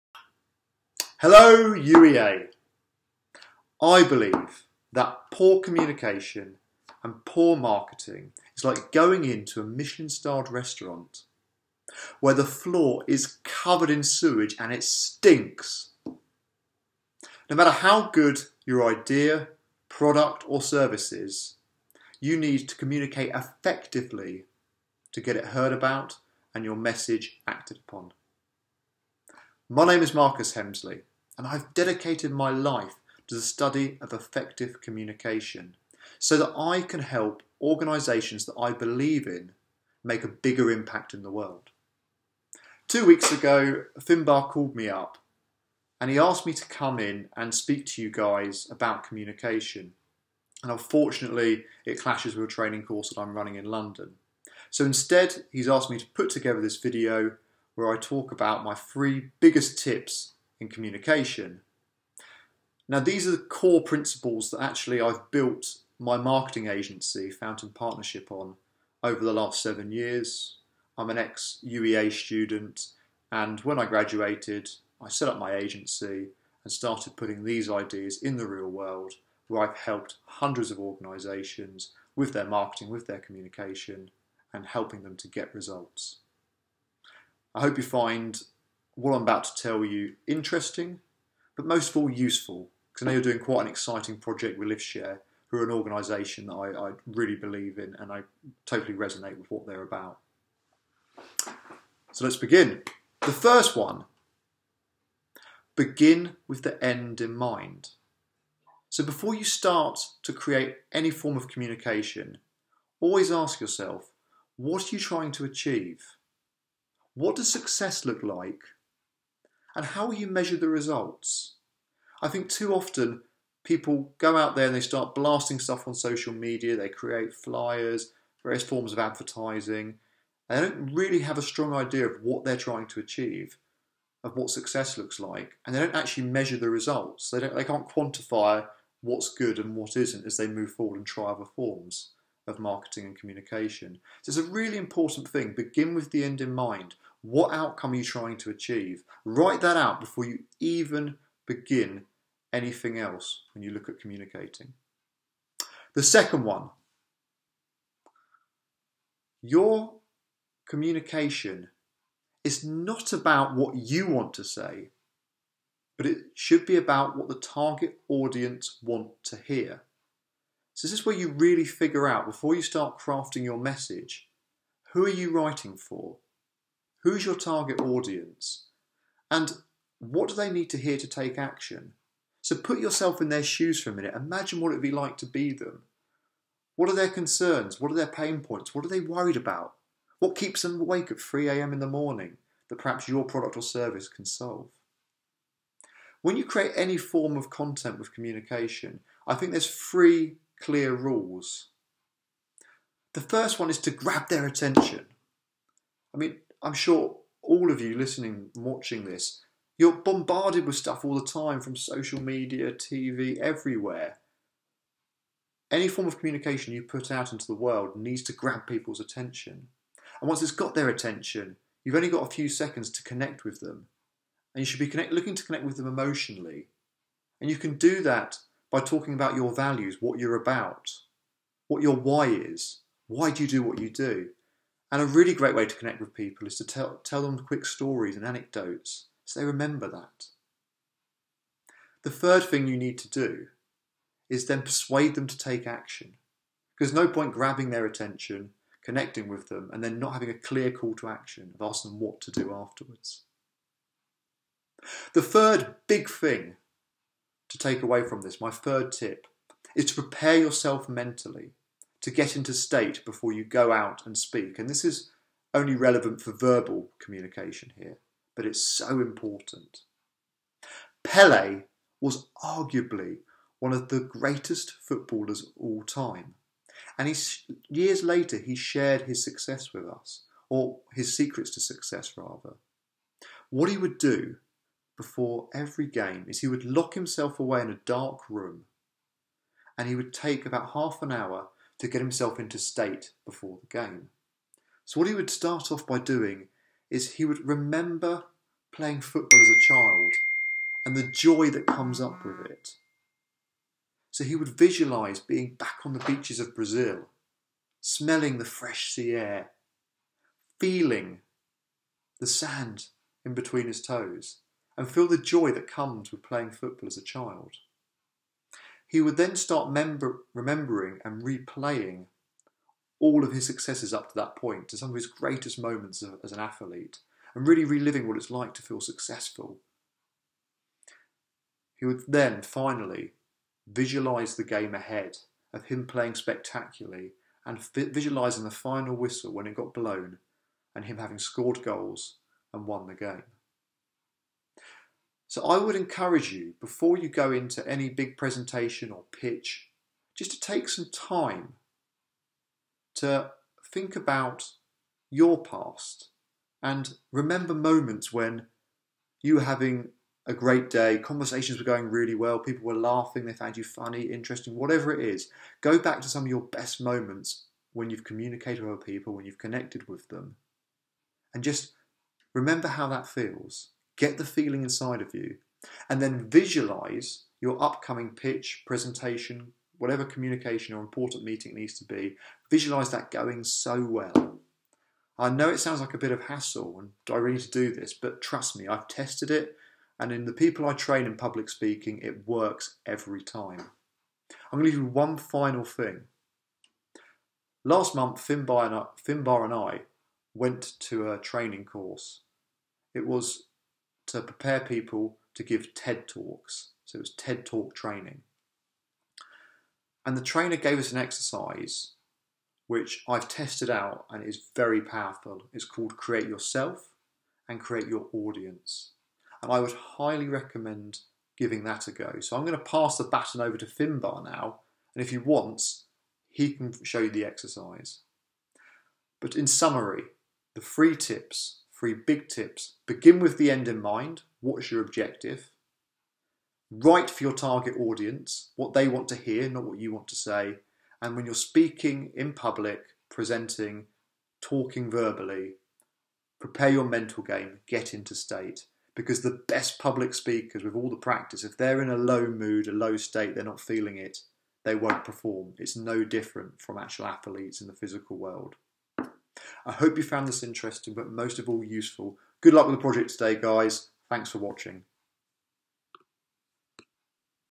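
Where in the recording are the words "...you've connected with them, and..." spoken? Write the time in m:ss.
6:09.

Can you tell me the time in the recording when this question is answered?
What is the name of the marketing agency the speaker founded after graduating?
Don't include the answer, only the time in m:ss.
1:07.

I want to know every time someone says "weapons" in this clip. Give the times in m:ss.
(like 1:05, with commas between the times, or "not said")
not said.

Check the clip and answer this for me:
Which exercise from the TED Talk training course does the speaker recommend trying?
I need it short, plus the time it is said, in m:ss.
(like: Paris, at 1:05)
Create Yourself and Create Your Audience, at 6:55.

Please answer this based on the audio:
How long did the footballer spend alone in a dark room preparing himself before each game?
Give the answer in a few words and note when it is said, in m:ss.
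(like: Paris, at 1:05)
half an hour, at 4:50.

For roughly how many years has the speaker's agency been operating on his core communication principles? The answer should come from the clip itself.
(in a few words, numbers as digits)
7.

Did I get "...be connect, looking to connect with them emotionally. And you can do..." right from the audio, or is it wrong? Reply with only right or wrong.
right.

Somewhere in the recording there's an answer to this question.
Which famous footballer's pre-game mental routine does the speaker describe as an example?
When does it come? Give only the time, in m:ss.
4:31.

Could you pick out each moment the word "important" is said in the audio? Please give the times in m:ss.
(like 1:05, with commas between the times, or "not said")
2:24, 4:28, 6:20.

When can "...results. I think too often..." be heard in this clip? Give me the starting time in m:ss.
2:00.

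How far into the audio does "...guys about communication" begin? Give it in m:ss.
0:48.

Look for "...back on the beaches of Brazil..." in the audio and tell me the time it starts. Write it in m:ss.
5:05.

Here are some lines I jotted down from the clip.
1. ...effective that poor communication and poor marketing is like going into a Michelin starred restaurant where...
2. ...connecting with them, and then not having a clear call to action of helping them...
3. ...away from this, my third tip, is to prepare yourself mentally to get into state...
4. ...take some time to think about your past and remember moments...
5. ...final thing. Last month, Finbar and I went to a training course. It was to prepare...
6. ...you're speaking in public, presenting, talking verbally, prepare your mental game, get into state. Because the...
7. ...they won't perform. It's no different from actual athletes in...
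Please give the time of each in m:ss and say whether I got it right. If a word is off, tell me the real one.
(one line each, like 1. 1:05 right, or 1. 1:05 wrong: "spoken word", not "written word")
1. 0:04 wrong: "believe", not "effective"
2. 4:08 wrong: "asking", not "helping"
3. 4:17 right
4. 5:50 right
5. 6:35 right
6. 7:21 right
7. 7:34 right.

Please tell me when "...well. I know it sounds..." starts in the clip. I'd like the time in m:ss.
6:23.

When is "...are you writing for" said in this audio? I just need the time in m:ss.
2:55.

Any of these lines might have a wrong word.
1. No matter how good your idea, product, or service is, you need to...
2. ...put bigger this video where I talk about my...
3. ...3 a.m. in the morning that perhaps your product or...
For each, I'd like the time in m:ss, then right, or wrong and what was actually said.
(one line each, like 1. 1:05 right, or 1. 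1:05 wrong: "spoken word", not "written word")
1. 0:16 right
2. 0:56 wrong: "together", not "bigger"
3. 3:11 right.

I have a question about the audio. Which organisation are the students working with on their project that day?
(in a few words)
LiftShare.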